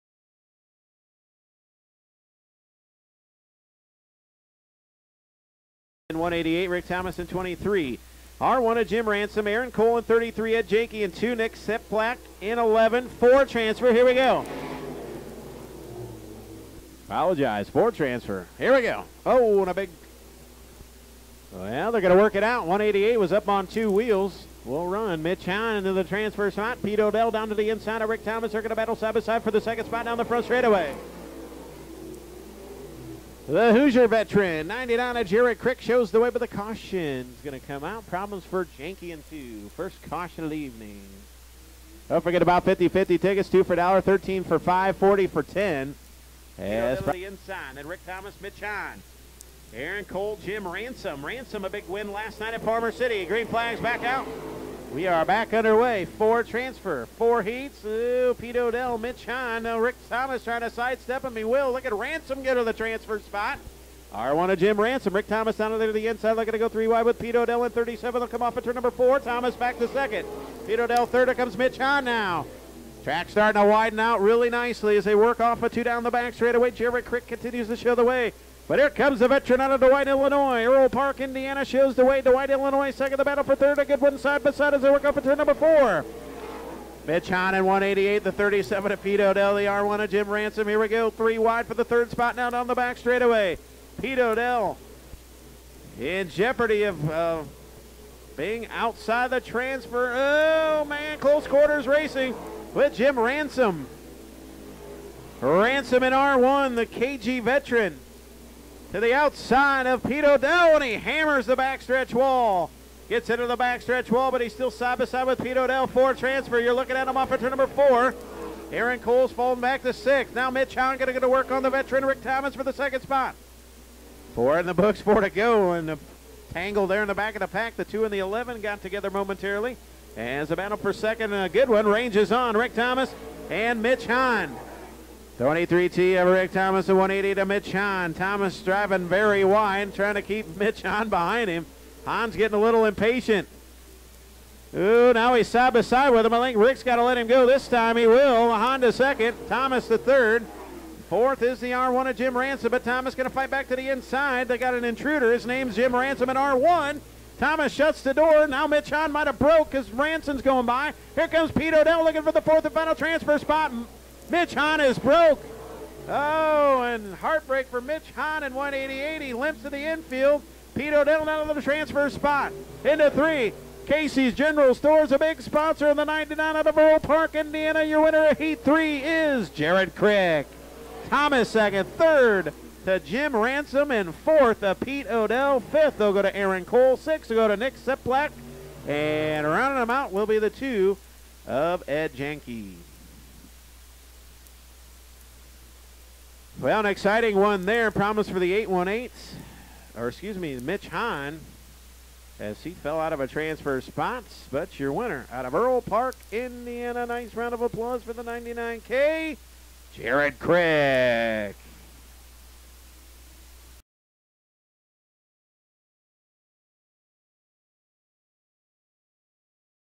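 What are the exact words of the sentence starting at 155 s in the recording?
His name's Jim Ransom in R1.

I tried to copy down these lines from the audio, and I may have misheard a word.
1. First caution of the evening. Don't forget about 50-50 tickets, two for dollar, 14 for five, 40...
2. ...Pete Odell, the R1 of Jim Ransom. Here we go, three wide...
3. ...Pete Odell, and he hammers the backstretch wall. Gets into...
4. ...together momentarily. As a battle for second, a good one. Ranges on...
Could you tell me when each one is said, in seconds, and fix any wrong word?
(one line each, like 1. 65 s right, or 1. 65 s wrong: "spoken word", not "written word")
1. 39 s wrong: "13", not "14"
2. 88 s right
3. 110 s right
4. 128 s right.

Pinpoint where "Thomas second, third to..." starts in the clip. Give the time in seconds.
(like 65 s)
181 s.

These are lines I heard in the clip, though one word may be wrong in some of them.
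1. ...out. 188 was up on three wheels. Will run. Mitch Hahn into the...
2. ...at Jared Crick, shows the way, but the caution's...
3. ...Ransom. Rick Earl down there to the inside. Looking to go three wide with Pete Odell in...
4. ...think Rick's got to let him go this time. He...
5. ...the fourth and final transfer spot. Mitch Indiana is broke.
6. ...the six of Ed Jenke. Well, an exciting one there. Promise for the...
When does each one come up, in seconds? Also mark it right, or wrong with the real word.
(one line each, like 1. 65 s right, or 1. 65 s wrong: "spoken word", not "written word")
1. 22 s wrong: "two", not "three"
2. 35 s right
3. 64 s wrong: "Thomas", not "Earl"
4. 146 s right
5. 162 s wrong: "Hahn", not "Indiana"
6. 190 s wrong: "two", not "six".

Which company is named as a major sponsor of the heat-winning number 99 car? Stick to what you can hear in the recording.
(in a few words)
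Casey's General Stores.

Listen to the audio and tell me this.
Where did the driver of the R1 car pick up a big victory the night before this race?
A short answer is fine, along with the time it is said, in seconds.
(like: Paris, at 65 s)
Farmer City, at 52 s.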